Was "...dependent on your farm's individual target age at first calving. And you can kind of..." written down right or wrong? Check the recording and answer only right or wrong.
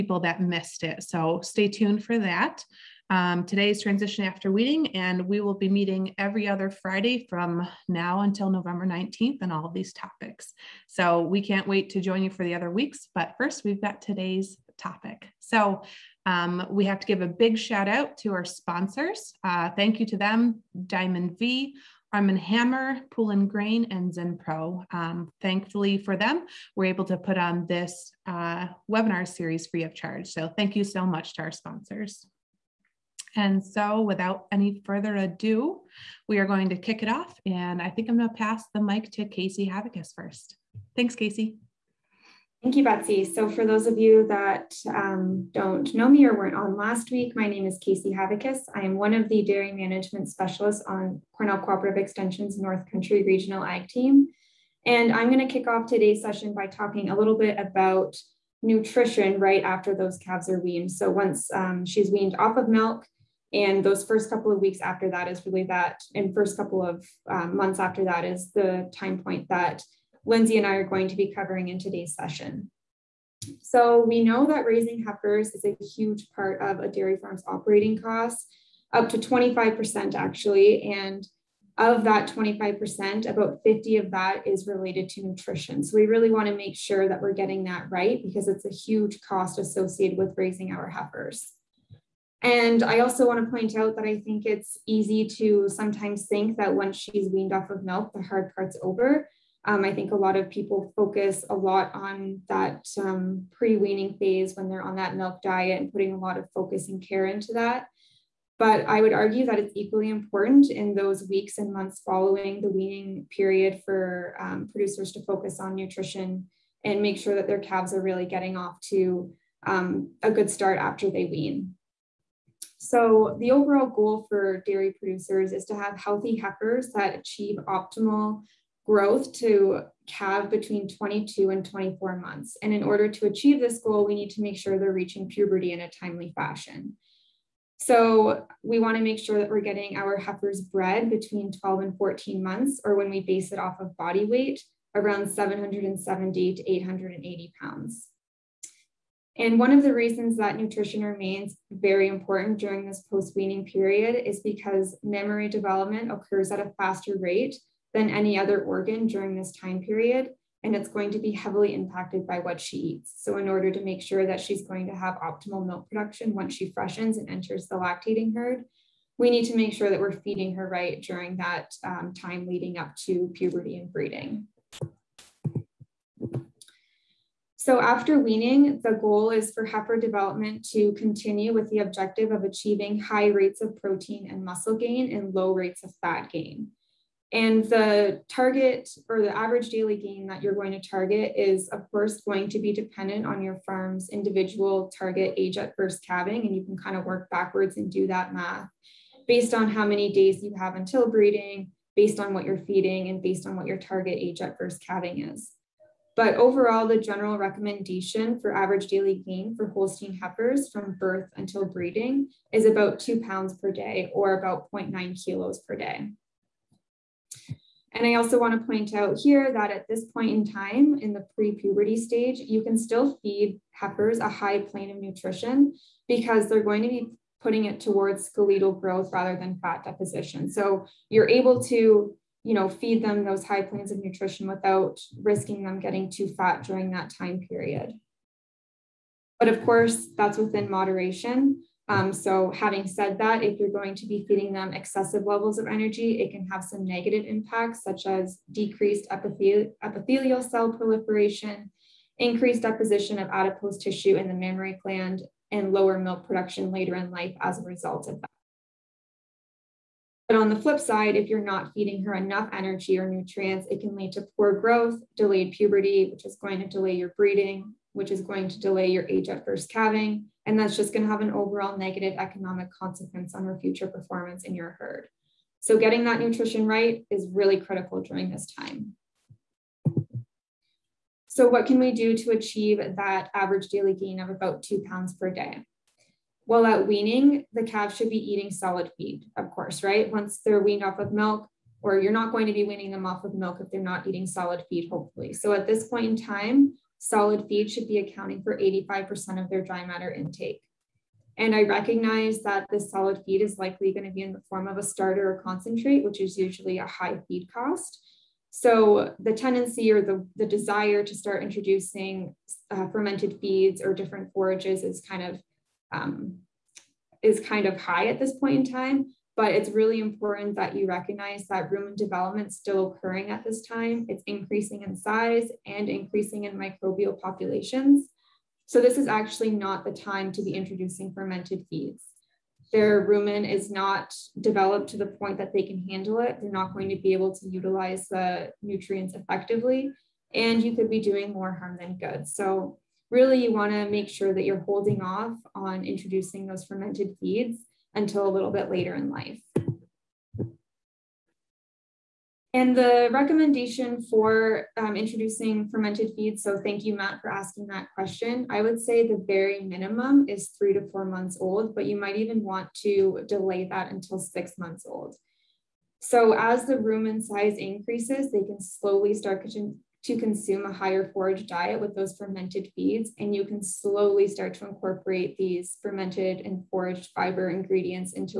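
right.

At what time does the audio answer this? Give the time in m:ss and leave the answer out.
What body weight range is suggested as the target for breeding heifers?
2:25.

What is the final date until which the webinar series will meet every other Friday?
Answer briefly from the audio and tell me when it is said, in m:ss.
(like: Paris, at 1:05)
November 19th, at 0:08.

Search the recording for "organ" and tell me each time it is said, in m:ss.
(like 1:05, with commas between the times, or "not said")
2:38.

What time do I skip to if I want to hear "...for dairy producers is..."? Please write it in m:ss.
2:04.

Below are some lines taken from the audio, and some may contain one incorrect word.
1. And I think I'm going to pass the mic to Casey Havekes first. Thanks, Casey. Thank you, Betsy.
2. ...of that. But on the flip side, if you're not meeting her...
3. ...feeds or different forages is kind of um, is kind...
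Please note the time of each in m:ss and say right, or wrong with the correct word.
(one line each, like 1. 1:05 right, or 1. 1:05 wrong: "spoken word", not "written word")
1. 0:37 right
2. 4:18 wrong: "feeding", not "meeting"
3. 5:13 right.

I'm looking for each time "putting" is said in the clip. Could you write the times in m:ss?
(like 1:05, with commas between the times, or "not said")
1:45, 3:47.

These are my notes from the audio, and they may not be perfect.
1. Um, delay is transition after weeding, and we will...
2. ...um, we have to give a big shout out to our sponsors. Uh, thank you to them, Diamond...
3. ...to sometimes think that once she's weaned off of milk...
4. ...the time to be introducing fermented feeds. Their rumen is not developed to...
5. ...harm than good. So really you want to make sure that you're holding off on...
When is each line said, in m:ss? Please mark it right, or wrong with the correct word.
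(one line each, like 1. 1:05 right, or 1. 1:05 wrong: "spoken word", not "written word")
1. 0:03 wrong: "today", not "delay"
2. 0:16 right
3. 1:35 right
4. 5:29 right
5. 5:41 right.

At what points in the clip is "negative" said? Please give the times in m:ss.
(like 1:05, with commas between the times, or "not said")
4:06, 4:31.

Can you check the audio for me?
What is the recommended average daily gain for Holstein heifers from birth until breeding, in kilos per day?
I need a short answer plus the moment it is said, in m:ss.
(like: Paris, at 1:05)
0.9, at 3:34.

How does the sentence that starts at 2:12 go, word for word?
And in order to achieve this goal, we need to make sure they're reaching puberty in a timely fashion.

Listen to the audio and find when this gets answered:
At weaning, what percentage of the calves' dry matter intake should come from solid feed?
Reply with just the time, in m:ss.
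4:58.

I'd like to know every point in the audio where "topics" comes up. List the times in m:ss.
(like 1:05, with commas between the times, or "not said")
0:09, 0:14.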